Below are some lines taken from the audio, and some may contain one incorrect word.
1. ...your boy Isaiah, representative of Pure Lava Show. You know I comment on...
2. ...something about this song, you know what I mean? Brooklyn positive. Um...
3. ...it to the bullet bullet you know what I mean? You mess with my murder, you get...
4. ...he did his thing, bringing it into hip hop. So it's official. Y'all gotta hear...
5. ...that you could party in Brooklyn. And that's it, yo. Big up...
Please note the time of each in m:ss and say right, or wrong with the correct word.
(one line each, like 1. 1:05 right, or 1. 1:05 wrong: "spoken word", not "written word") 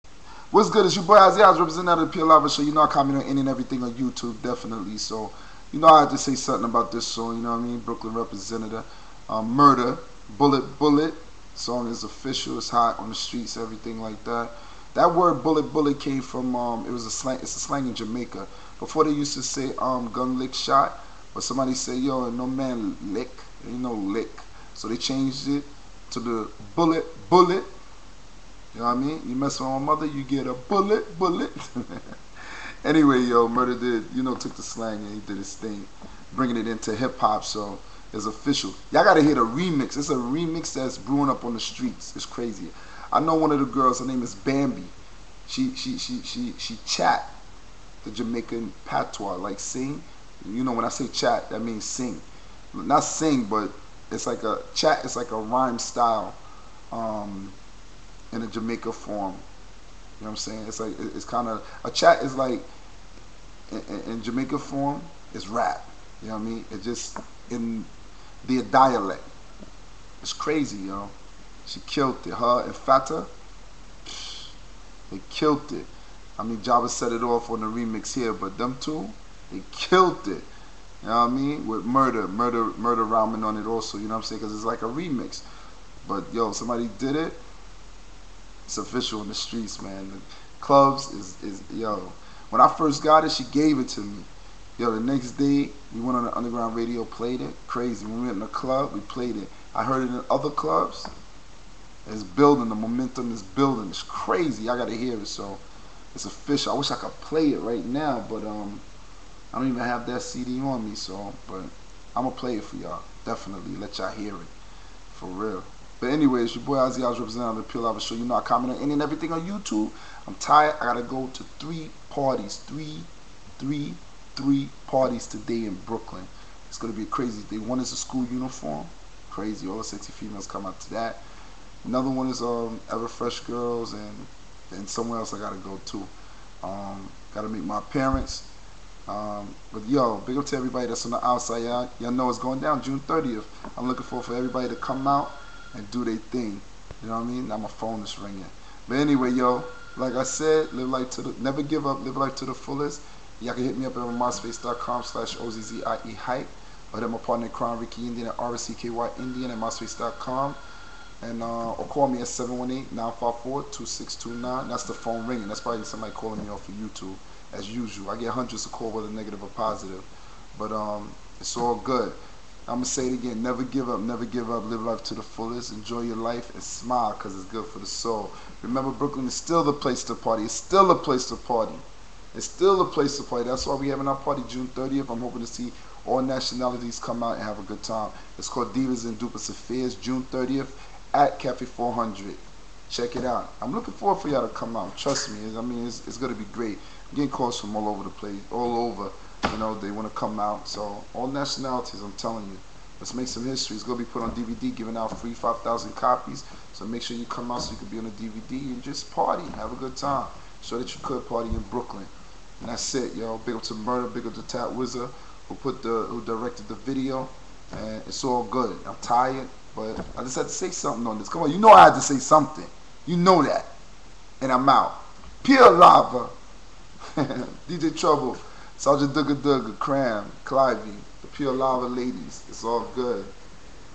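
1. 0:00 right
2. 0:06 wrong: "representative", not "positive"
3. 0:25 wrong: "mother", not "murder"
4. 0:35 right
5. 3:30 right.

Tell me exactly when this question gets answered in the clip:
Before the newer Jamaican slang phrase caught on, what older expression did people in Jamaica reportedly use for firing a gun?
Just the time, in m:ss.
0:20.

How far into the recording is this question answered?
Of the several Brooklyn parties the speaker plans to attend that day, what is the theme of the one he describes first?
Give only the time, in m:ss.
2:07.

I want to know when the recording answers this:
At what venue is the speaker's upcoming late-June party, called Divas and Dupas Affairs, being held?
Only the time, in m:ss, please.
3:11.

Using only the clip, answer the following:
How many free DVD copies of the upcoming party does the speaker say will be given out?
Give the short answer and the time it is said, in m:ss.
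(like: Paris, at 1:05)
5,000, at 3:25.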